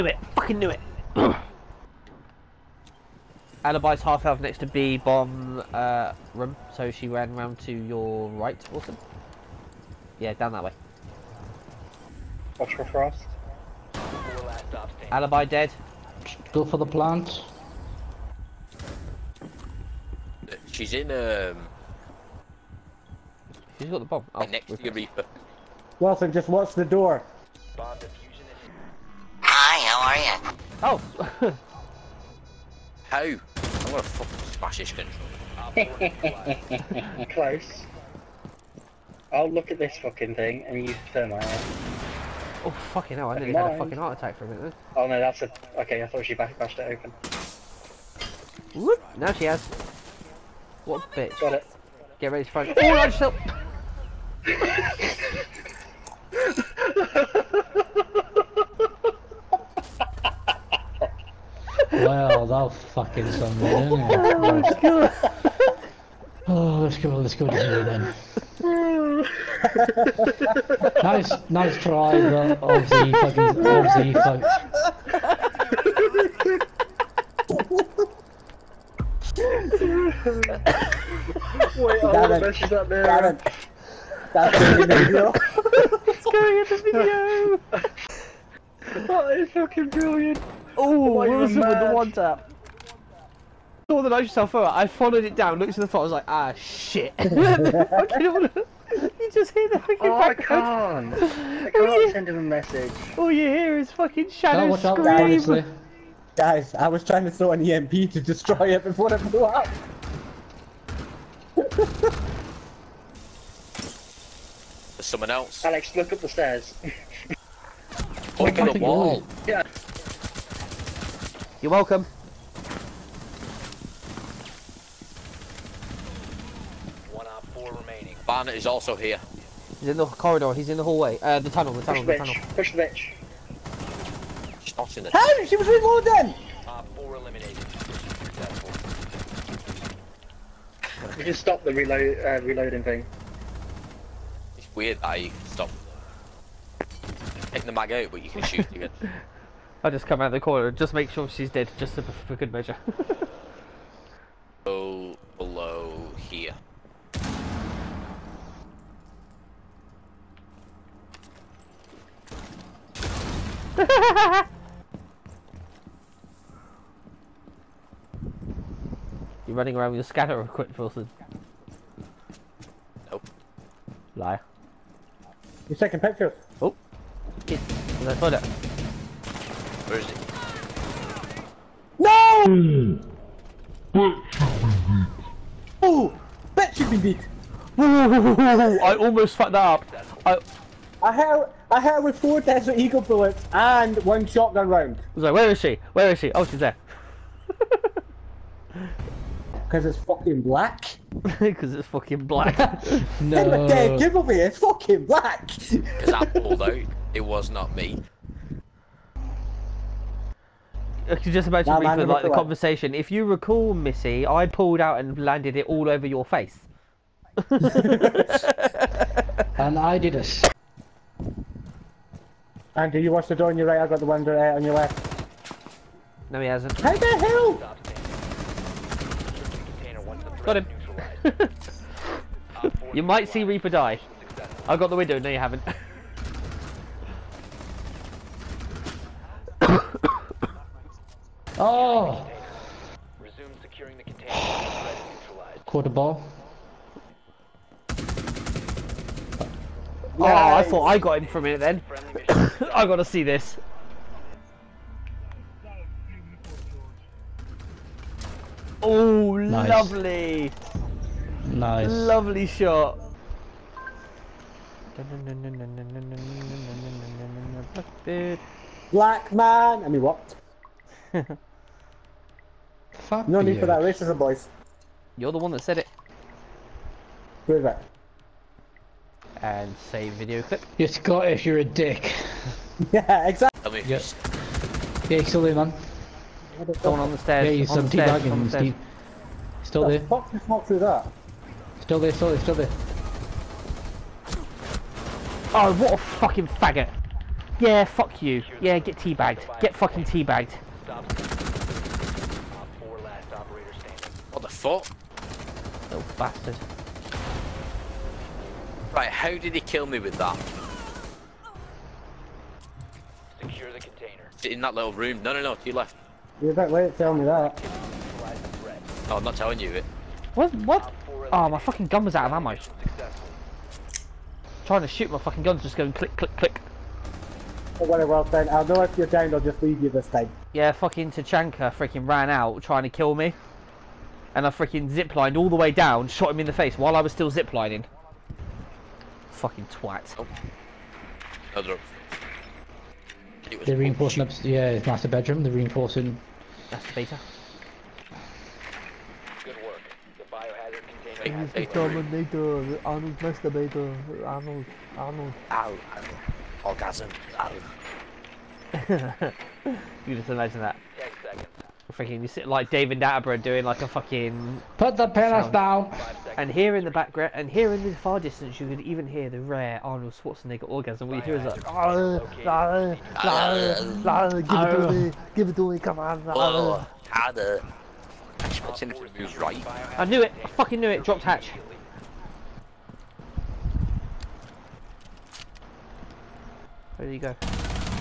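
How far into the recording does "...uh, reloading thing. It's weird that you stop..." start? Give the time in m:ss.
2:22.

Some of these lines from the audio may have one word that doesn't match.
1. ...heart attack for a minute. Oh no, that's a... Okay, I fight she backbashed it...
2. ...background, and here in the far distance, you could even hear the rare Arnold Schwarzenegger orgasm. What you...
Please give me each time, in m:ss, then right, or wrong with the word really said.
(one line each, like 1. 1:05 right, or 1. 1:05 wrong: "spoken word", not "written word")
1. 0:43 wrong: "thought", not "fight"
2. 6:06 right.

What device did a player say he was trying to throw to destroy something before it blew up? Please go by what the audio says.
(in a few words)
An EMP.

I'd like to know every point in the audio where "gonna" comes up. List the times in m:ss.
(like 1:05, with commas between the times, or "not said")
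0:33.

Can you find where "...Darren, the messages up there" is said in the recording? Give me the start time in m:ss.
1:22.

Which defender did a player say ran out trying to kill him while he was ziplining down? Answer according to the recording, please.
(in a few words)
Tachanka.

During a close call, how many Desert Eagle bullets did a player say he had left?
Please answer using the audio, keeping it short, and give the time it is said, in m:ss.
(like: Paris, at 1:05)
4, at 3:12.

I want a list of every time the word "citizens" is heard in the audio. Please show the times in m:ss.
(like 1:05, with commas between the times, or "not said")
not said.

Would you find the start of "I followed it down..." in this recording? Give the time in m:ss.
1:34.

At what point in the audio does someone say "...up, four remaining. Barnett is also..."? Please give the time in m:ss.
2:07.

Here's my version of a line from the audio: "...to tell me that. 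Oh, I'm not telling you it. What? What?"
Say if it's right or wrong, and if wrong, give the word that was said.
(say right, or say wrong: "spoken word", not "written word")
right.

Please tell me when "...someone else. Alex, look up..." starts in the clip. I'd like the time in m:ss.
1:55.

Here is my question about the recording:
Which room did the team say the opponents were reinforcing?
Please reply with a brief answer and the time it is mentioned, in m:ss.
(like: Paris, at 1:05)
Master bedroom, at 5:44.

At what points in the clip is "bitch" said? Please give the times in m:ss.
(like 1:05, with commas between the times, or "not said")
0:51, 2:12.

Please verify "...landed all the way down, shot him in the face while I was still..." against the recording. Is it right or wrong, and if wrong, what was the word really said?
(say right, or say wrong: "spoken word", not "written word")
wrong: "ziplined", not "landed".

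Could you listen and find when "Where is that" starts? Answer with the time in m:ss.
4:37.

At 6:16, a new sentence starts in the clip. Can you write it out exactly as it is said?
Oh, ah, how the hatch moves right.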